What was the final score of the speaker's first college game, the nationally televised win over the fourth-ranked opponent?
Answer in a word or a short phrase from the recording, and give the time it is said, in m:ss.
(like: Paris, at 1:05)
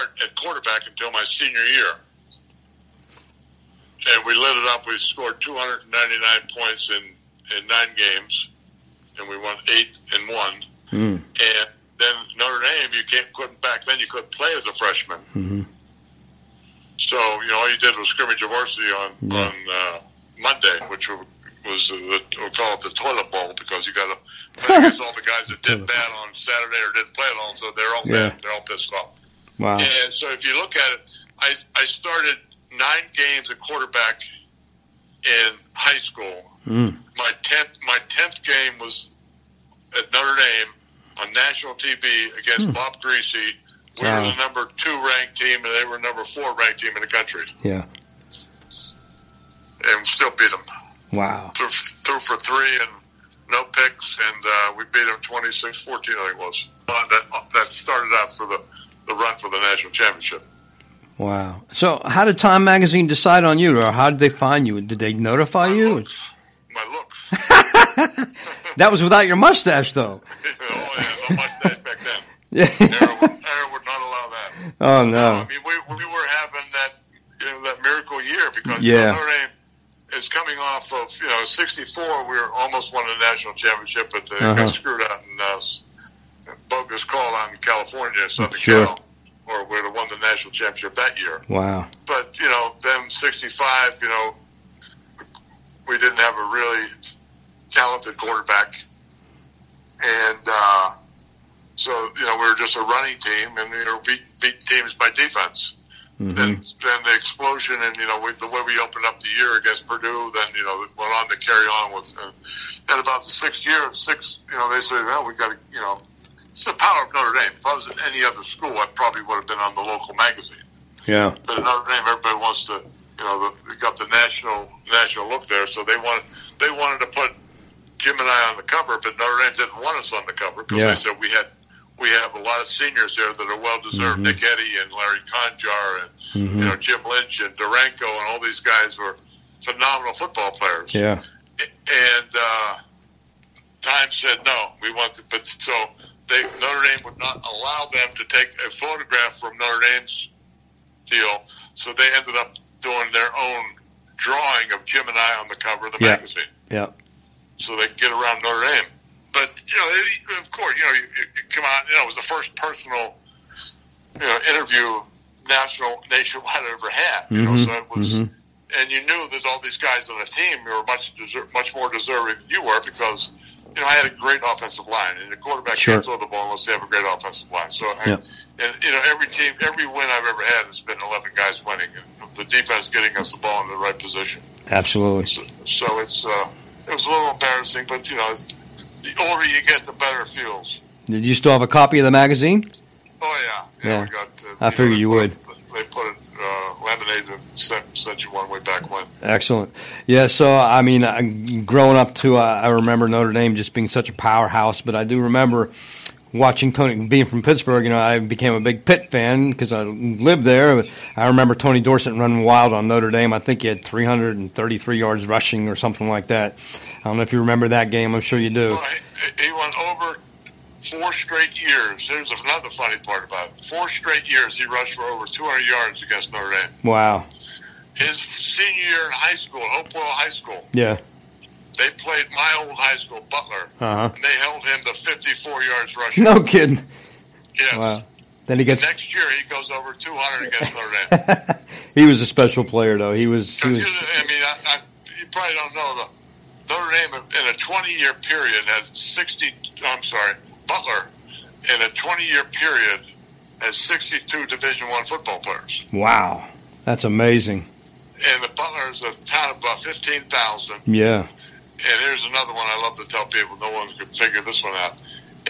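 26-14, at 0:55.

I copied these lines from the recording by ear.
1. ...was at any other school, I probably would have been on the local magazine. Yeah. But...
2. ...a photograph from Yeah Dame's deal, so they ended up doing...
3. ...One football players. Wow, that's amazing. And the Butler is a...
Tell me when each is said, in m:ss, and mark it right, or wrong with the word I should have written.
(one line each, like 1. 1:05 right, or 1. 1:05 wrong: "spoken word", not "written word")
1. 1:57 right
2. 2:28 wrong: "Notre", not "Yeah"
3. 4:14 right.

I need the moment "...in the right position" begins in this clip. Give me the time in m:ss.
3:03.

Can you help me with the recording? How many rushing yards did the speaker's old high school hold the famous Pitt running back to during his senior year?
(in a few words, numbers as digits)
54.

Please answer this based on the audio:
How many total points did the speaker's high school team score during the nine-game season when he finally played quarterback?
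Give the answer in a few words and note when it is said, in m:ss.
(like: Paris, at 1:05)
299, at 0:05.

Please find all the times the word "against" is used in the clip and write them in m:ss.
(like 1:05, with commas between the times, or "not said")
0:24, 0:42, 1:49, 3:46, 4:00.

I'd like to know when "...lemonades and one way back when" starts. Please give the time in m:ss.
3:16.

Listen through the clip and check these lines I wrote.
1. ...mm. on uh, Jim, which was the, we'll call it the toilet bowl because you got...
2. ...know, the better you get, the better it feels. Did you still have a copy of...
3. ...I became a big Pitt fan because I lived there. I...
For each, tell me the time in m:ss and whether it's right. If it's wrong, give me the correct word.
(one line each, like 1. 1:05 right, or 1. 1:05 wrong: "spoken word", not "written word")
1. 0:19 wrong: "Monday", not "Jim"
2. 3:08 wrong: "older", not "better"
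3. 3:27 right.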